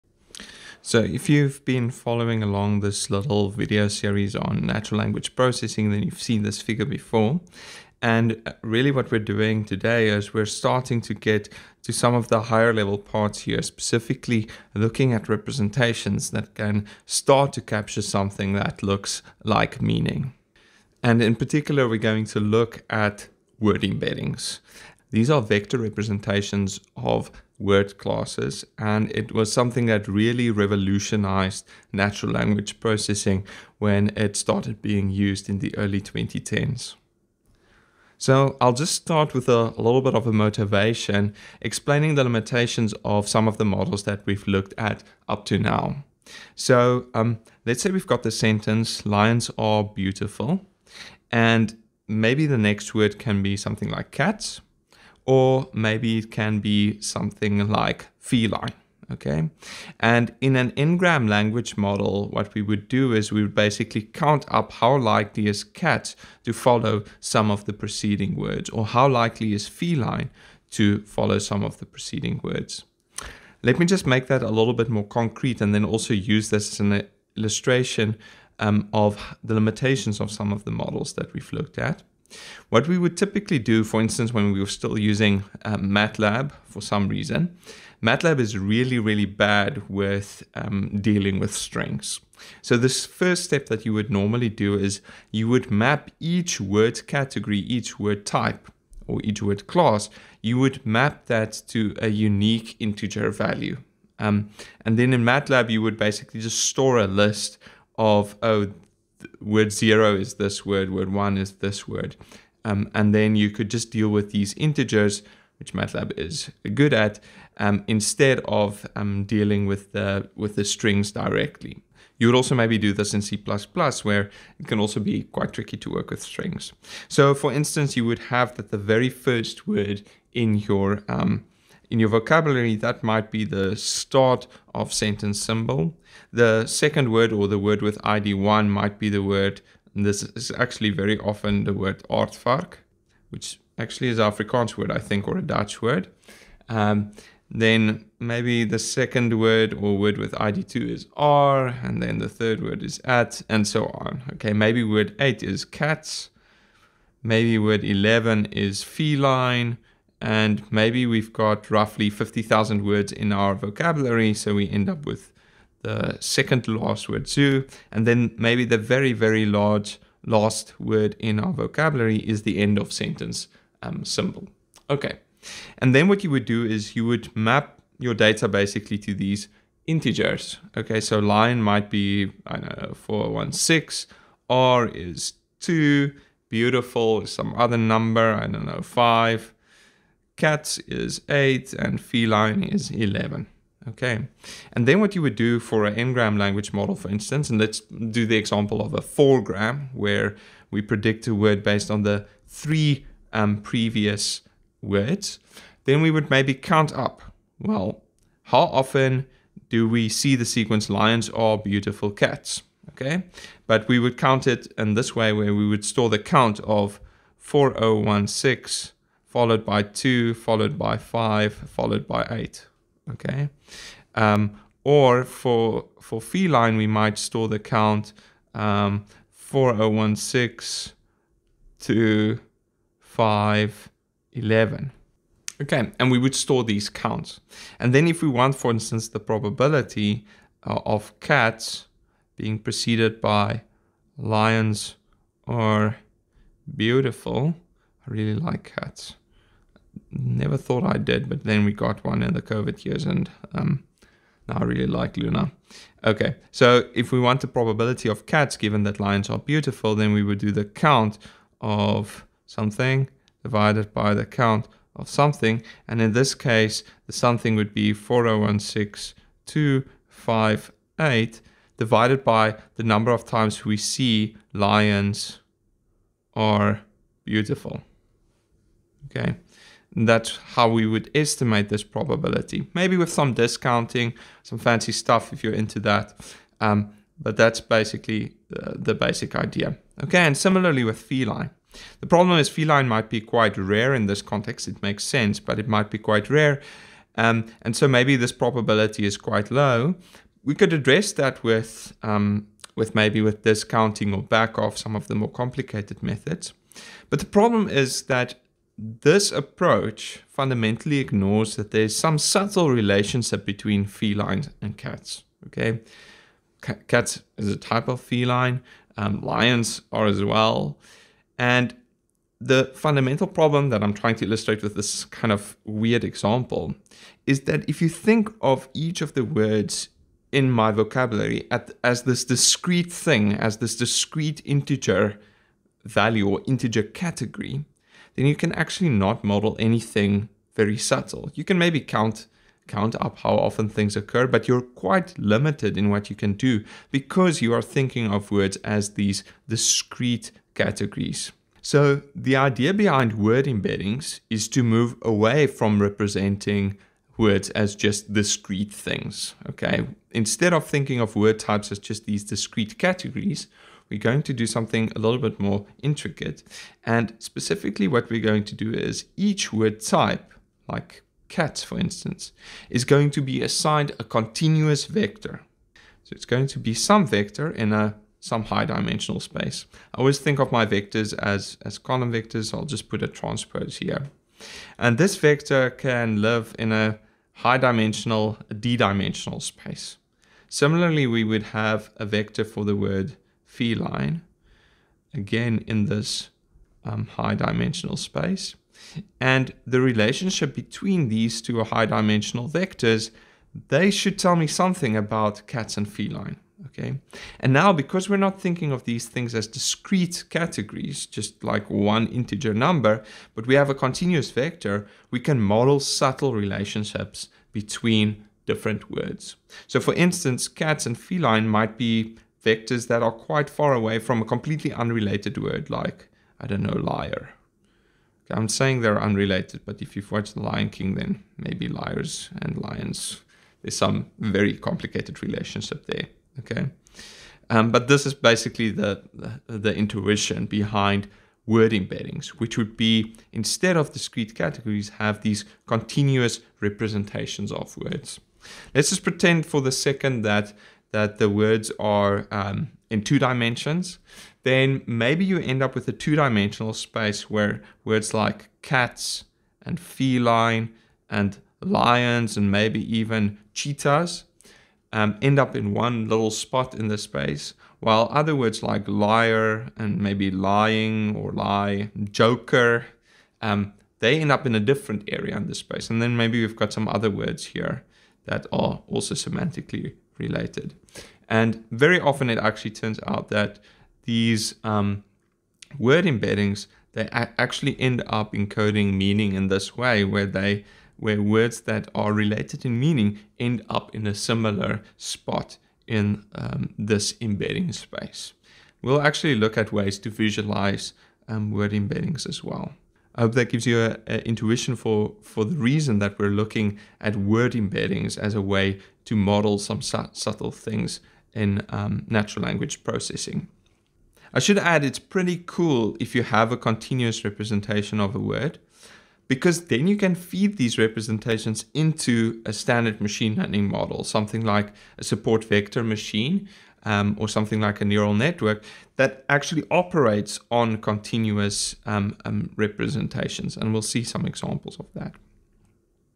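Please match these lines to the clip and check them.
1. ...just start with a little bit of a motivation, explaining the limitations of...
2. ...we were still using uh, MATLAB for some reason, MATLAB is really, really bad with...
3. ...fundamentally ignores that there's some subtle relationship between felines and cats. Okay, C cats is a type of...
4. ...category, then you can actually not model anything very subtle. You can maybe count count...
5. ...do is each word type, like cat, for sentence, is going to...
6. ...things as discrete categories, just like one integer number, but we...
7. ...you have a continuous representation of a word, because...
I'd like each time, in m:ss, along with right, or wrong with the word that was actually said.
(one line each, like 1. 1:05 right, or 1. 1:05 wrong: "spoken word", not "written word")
1. 0:38 right
2. 1:24 right
3. 5:10 right
4. 5:36 right
5. 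6:08 wrong: "instance", not "sentence"
6. 6:49 right
7. 8:36 right.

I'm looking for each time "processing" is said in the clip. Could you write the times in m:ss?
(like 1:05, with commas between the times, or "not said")
0:05, 0:32, 8:32.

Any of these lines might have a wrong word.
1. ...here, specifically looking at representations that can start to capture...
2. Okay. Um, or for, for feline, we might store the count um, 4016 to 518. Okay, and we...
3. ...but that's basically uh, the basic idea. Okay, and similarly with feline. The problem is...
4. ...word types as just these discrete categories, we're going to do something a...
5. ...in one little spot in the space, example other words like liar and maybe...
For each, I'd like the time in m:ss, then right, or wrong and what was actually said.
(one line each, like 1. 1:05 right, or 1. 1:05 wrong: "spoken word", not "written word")
1. 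0:13 right
2. 3:43 wrong: "511", not "518"
3. 4:47 right
4. 6:01 right
5. 7:45 wrong: "while", not "example".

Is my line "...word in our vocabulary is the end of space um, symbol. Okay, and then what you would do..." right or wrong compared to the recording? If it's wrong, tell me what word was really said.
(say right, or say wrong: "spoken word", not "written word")
wrong: "sentence", not "space".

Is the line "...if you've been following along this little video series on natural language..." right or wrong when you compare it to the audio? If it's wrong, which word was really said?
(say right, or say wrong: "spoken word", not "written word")
right.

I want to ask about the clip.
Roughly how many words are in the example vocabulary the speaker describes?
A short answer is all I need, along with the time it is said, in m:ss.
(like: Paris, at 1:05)
50,000, at 2:42.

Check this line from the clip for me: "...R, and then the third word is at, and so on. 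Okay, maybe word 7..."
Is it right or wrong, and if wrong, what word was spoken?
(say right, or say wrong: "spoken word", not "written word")
wrong: "8", not "7".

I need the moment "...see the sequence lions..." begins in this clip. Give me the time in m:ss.
3:30.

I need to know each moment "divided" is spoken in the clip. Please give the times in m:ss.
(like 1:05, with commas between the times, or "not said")
4:23, 4:31.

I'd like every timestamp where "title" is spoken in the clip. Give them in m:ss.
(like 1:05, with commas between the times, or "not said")
not said.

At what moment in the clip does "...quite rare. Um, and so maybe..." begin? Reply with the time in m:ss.
4:55.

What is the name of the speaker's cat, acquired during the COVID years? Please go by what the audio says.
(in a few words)
Luna.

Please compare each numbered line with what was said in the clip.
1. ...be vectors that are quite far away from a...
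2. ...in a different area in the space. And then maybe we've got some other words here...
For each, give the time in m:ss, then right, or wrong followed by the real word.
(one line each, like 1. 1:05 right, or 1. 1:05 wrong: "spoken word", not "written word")
1. 7:01 right
2. 7:54 right.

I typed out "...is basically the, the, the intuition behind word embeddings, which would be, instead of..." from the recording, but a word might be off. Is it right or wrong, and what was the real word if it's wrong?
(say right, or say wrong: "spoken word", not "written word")
right.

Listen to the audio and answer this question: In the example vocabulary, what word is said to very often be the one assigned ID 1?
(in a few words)
aardvark.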